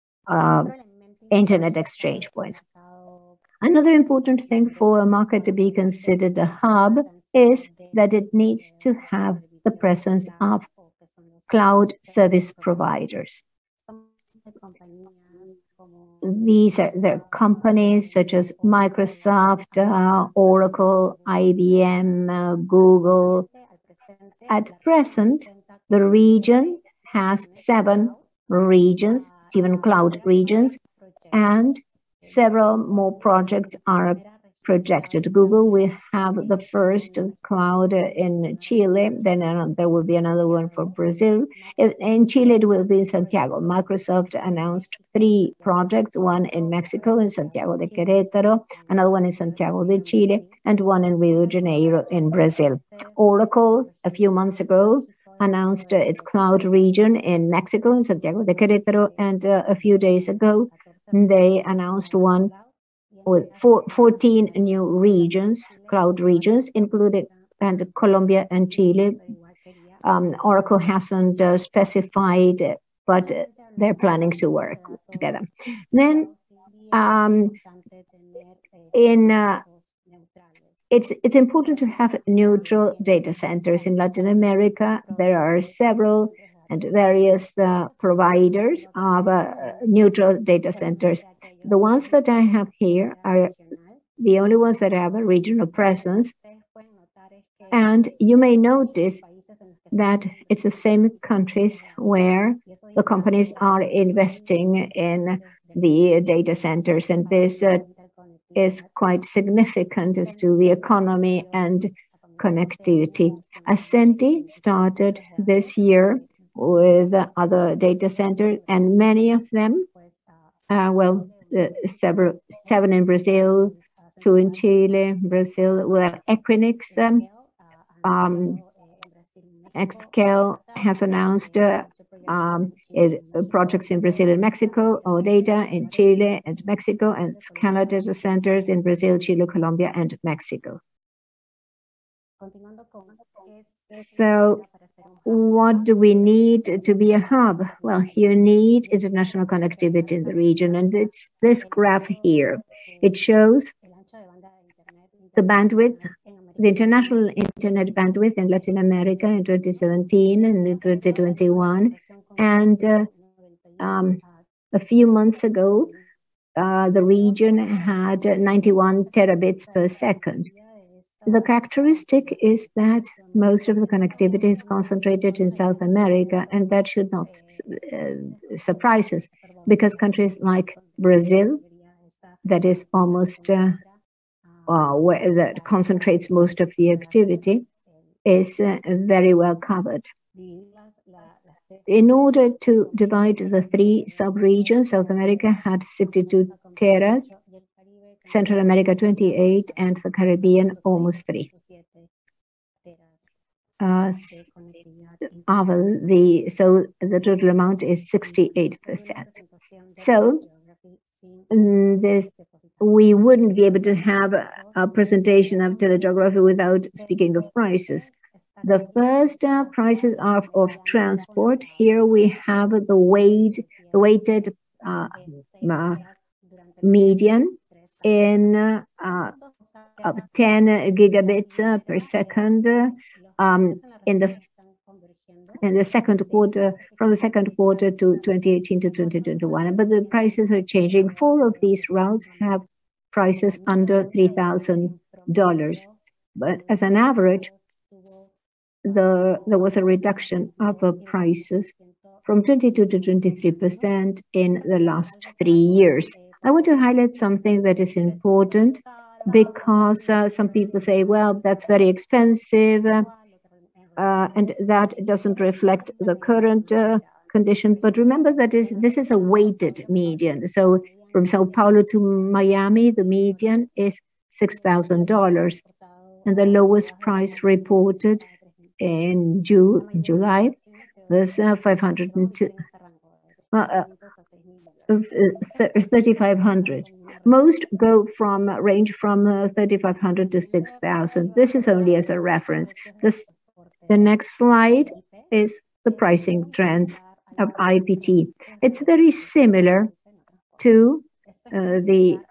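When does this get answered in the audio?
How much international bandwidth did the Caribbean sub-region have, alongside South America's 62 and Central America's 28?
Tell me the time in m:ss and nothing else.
3:20.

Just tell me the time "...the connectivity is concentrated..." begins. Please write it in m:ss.
2:53.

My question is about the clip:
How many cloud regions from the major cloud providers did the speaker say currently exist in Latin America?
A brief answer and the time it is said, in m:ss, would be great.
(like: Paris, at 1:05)
7, at 0:29.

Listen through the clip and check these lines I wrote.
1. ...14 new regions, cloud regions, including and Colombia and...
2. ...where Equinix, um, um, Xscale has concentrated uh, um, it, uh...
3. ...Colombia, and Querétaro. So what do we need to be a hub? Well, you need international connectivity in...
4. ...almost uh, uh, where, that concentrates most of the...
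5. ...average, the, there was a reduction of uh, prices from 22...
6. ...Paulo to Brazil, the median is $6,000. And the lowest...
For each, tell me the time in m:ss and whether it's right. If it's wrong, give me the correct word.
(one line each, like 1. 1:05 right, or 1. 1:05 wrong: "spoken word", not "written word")
1. 1:03 right
2. 2:05 wrong: "announced", not "concentrated"
3. 2:19 wrong: "Mexico", not "Querétaro"
4. 3:02 right
5. 4:06 right
6. 4:31 wrong: "Miami", not "Brazil".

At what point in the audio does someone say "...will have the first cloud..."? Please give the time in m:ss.
0:35.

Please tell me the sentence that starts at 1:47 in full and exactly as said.
And this uh, is quite significant as to the economy and connectivity.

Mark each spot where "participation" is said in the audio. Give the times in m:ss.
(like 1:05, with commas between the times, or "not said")
not said.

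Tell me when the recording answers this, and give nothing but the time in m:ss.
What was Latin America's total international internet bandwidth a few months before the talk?
2:48.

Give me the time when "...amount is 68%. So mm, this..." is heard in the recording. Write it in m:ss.
3:27.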